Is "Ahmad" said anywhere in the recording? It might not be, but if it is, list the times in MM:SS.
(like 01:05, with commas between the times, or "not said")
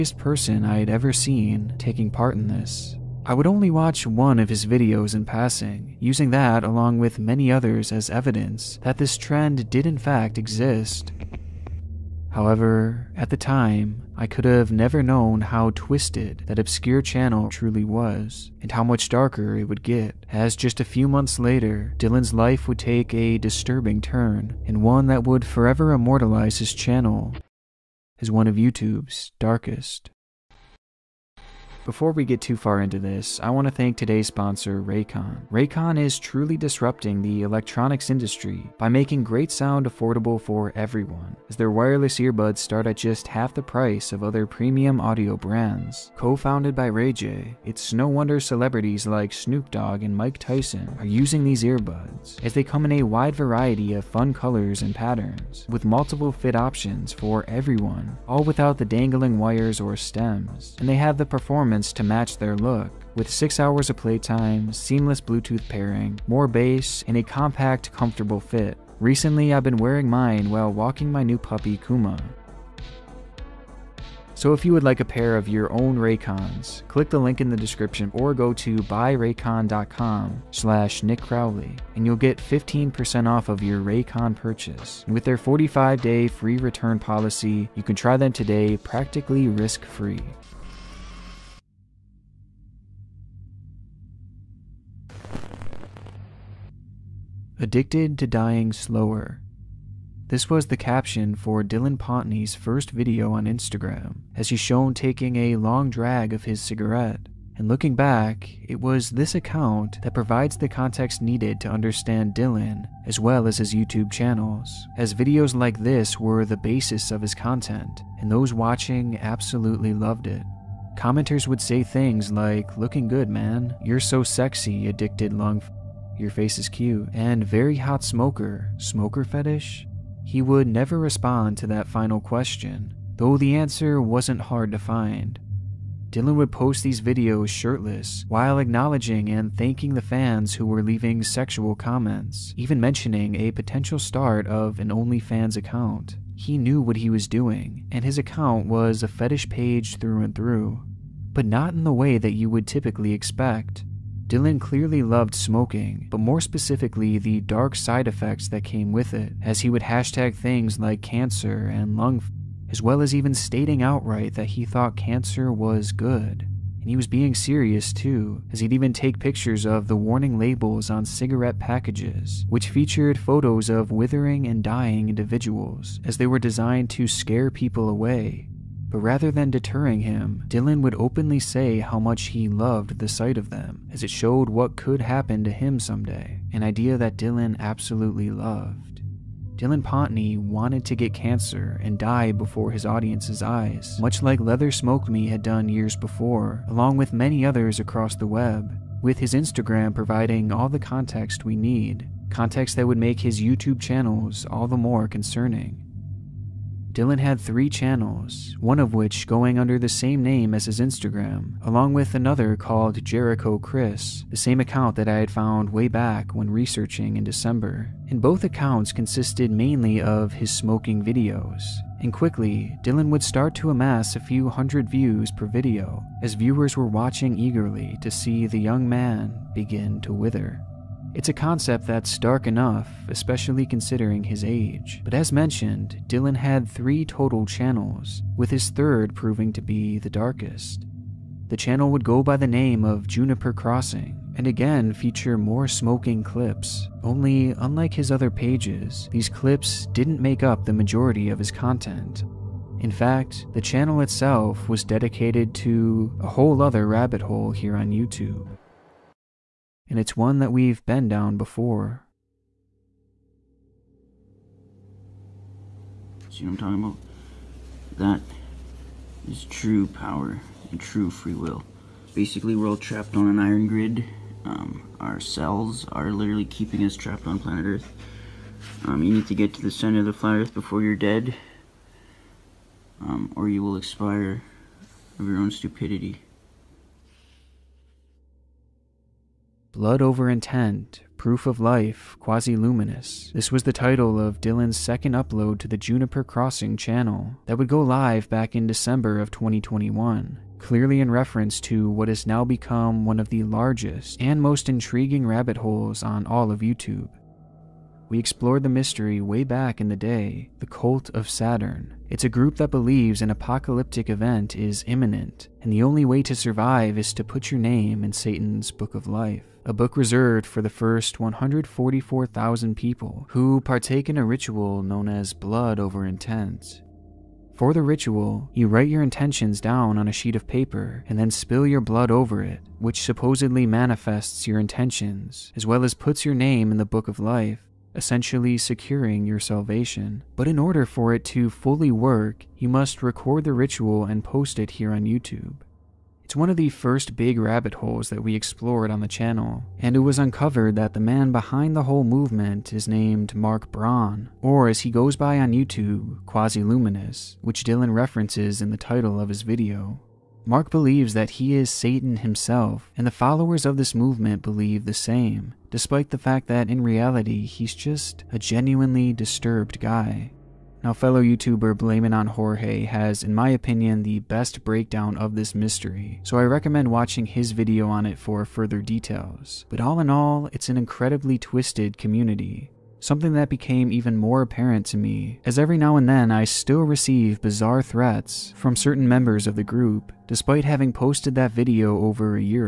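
not said.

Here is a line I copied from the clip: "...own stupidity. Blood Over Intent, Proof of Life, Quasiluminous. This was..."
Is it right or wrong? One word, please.
right.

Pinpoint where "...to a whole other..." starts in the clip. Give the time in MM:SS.
04:15.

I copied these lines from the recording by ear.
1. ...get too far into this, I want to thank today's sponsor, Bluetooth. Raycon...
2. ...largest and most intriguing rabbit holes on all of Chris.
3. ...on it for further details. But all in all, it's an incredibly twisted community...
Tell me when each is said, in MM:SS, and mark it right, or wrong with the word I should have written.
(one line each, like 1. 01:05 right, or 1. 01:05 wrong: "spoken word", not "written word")
1. 00:32 wrong: "Raycon", not "Bluetooth"
2. 05:03 wrong: "YouTube", not "Chris"
3. 06:17 right.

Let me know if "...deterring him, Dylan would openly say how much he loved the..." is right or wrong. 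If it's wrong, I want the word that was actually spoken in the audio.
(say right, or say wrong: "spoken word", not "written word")
right.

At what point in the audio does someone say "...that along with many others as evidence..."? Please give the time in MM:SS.
00:06.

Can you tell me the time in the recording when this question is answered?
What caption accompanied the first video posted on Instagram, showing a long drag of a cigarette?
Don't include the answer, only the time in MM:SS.
01:37.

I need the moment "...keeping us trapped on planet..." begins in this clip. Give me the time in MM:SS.
04:36.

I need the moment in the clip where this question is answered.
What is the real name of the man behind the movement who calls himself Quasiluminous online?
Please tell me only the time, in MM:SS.
05:53.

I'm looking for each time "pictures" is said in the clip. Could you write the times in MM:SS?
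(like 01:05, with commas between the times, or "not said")
02:49.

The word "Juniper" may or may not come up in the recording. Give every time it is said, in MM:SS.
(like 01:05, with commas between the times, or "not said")
04:03, 04:55.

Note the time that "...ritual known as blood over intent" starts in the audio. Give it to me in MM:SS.
05:24.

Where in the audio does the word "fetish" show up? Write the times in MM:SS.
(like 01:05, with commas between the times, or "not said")
02:09, 02:29.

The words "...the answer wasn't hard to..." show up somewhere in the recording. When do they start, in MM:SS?
02:13.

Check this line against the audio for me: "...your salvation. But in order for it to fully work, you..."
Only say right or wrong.
right.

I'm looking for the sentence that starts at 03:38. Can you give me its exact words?
And both accounts consisted mainly of his smoking videos.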